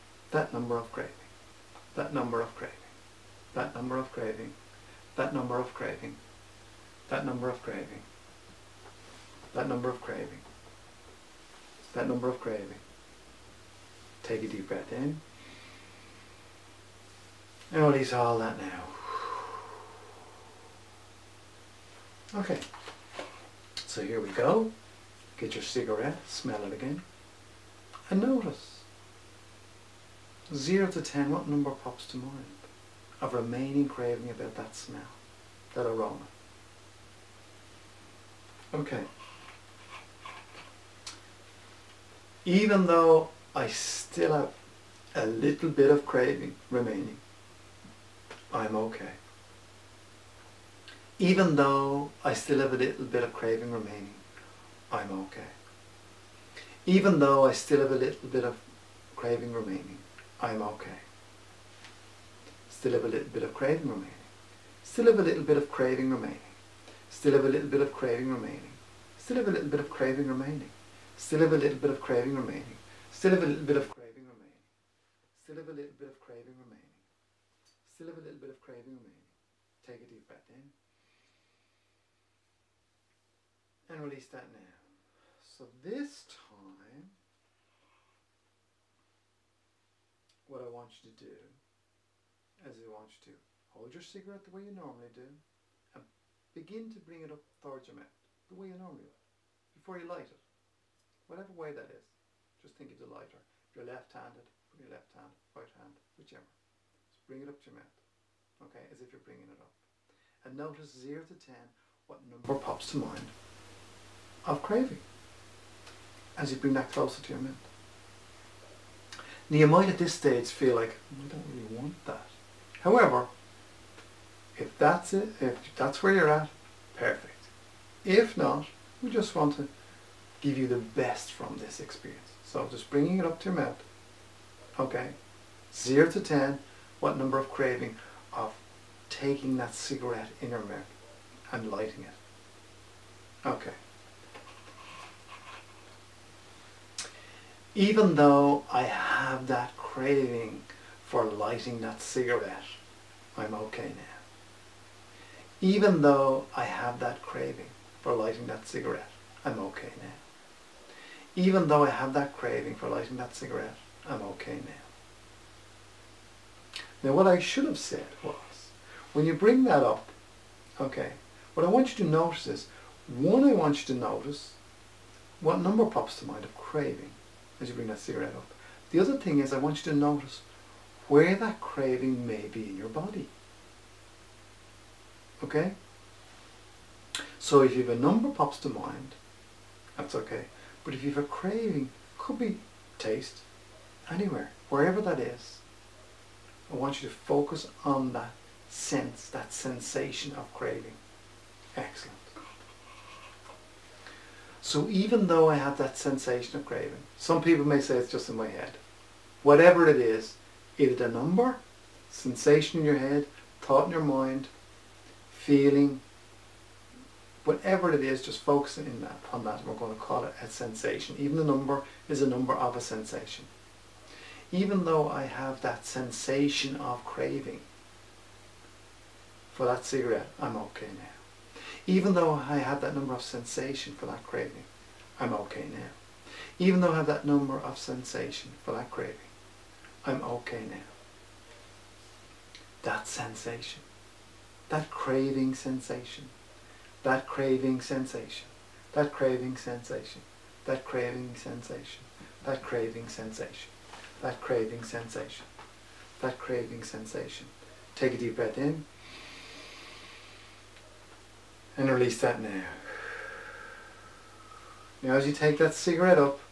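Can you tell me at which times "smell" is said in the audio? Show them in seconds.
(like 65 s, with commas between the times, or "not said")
26 s, 34 s.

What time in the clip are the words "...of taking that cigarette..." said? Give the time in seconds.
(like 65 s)
138 s.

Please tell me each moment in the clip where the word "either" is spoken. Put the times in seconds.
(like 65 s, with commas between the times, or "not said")
210 s.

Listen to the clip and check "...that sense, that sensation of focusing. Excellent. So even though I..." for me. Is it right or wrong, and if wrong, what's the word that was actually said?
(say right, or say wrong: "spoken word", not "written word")
wrong: "craving", not "focusing".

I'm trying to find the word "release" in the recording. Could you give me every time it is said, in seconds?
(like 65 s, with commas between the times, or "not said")
17 s, 84 s, 261 s.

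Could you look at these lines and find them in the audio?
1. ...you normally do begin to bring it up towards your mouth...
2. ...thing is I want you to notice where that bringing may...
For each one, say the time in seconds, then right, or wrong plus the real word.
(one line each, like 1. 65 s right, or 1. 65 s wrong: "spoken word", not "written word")
1. 94 s right
2. 179 s wrong: "craving", not "bringing".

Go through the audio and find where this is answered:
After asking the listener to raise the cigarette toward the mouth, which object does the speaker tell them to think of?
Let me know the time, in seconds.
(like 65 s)
102 s.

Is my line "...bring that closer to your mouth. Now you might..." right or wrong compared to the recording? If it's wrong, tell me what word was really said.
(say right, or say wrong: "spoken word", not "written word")
right.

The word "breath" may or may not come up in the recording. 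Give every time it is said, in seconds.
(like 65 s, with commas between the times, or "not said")
14 s, 80 s, 258 s.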